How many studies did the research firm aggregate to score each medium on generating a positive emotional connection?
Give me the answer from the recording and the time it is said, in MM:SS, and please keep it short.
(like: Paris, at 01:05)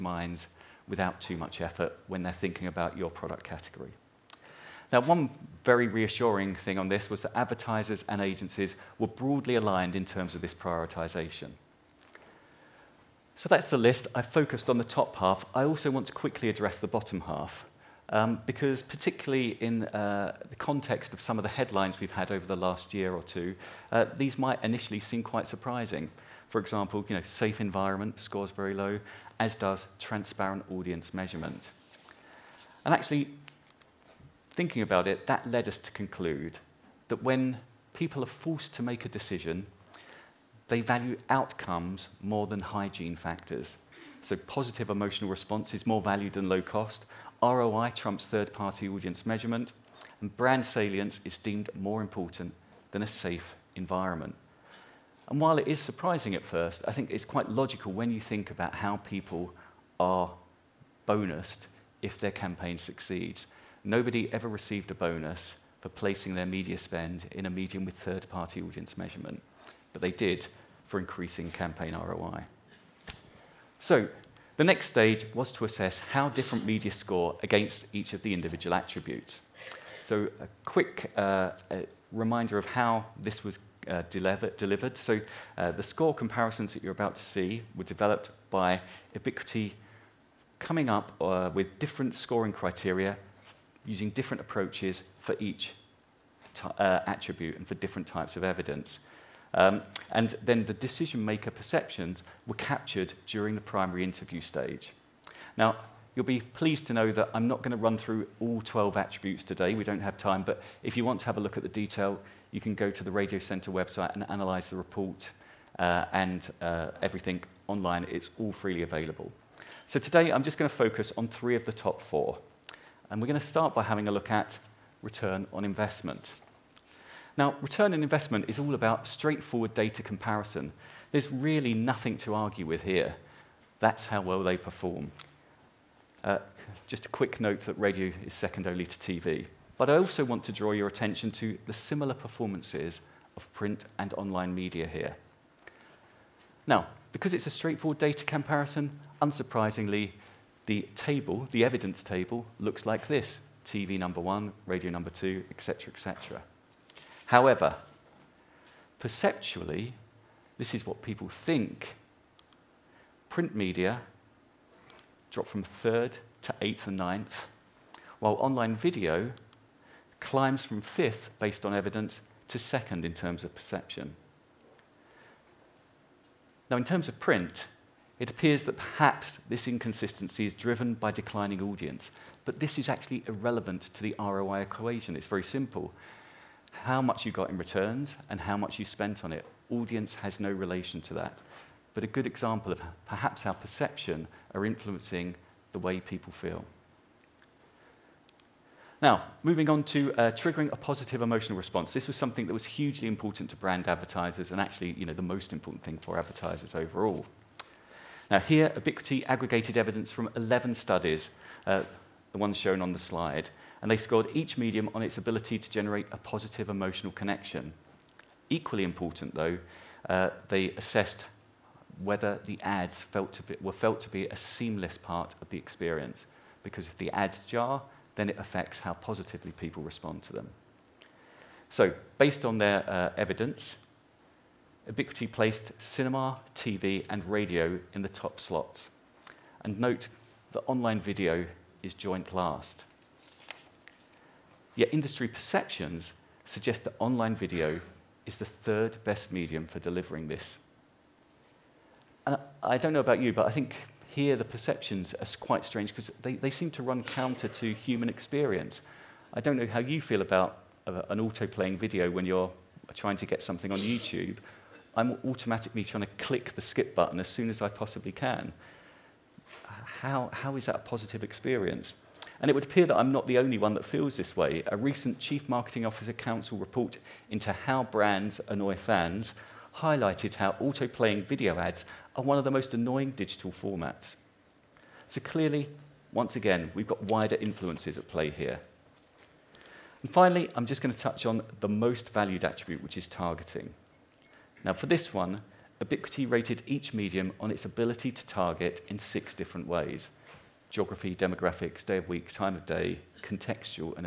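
11, at 03:30.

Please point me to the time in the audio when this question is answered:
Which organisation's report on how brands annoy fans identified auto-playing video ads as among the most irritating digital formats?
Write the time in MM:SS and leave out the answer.
04:35.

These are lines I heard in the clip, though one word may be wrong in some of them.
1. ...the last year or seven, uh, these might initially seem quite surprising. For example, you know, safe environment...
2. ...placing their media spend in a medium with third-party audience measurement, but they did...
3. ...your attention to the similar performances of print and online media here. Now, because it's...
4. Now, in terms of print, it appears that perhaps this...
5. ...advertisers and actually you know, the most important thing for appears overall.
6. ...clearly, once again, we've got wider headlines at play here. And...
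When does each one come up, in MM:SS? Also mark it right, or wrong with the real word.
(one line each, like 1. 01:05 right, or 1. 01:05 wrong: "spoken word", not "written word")
1. 00:22 wrong: "two", not "seven"
2. 01:05 right
3. 02:20 right
4. 02:56 right
5. 03:23 wrong: "advertisers", not "appears"
6. 04:45 wrong: "influences", not "headlines".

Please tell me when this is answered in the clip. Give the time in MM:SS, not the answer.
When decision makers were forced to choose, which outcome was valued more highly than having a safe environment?
00:50.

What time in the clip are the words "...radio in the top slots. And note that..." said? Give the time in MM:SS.
03:57.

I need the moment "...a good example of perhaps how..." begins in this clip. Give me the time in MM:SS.
03:12.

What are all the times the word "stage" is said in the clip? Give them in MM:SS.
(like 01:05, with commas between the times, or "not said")
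01:14, 01:44.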